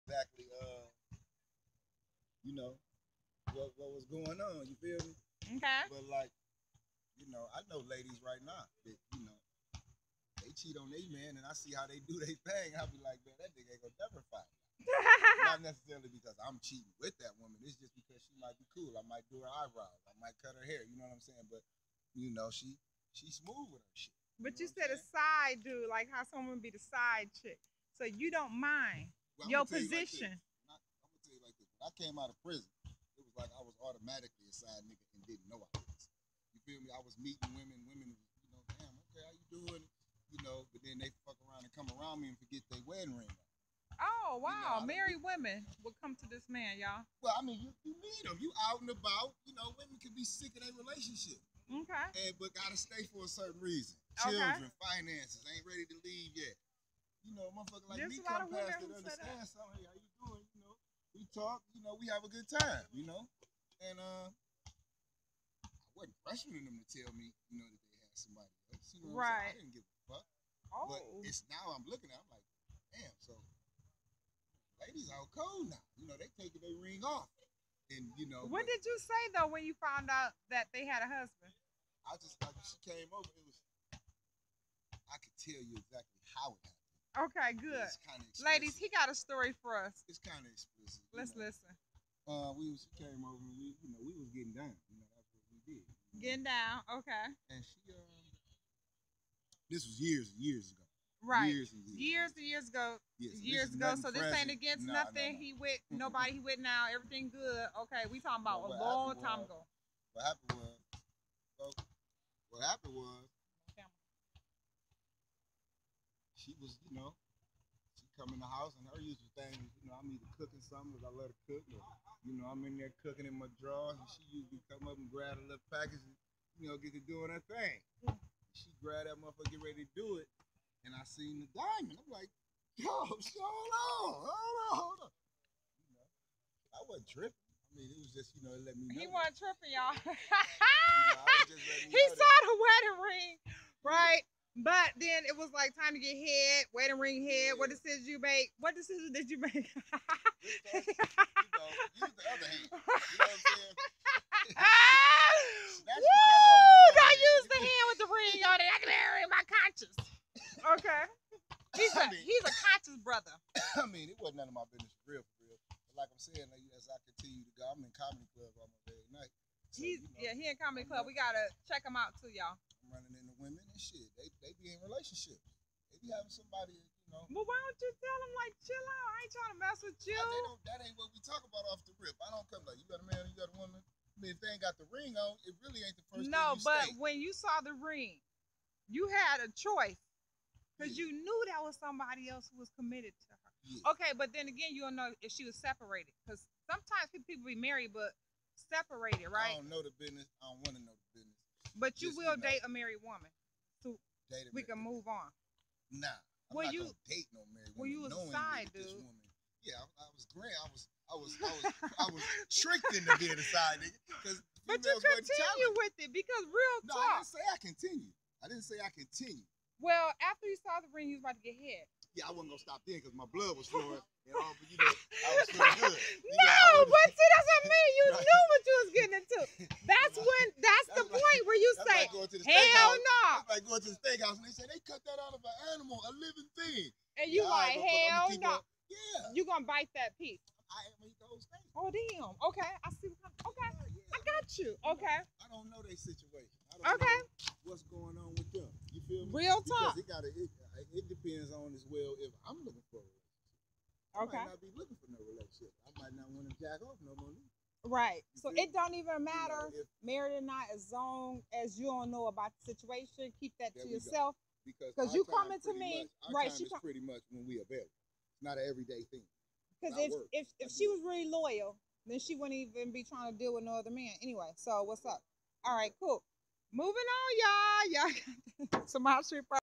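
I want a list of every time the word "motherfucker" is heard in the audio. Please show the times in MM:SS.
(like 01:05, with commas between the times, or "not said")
00:57, 02:09.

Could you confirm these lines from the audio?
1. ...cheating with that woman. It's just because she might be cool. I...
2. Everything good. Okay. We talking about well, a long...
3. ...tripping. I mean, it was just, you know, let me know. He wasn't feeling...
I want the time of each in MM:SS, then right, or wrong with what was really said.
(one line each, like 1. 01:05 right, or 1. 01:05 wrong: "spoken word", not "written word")
1. 00:16 right
2. 01:46 right
3. 02:17 wrong: "tripping", not "feeling".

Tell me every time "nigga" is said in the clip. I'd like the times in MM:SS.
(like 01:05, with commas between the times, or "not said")
00:13, 00:34, 03:33.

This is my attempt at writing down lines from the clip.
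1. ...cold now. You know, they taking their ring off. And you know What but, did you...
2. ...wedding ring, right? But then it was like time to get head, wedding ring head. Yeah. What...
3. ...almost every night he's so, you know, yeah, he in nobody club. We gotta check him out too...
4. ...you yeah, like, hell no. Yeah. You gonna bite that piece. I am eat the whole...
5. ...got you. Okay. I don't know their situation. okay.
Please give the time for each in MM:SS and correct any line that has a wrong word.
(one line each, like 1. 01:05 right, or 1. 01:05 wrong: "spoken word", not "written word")
1. 01:15 right
2. 02:22 right
3. 02:48 wrong: "comedy", not "nobody"
4. 03:57 right
5. 04:04 right.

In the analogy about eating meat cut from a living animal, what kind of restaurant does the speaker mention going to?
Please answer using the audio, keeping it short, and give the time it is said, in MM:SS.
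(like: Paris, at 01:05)
steakhouse, at 03:54.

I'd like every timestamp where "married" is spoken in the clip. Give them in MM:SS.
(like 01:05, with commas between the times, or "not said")
00:44, 03:17, 03:22, 03:27, 04:20.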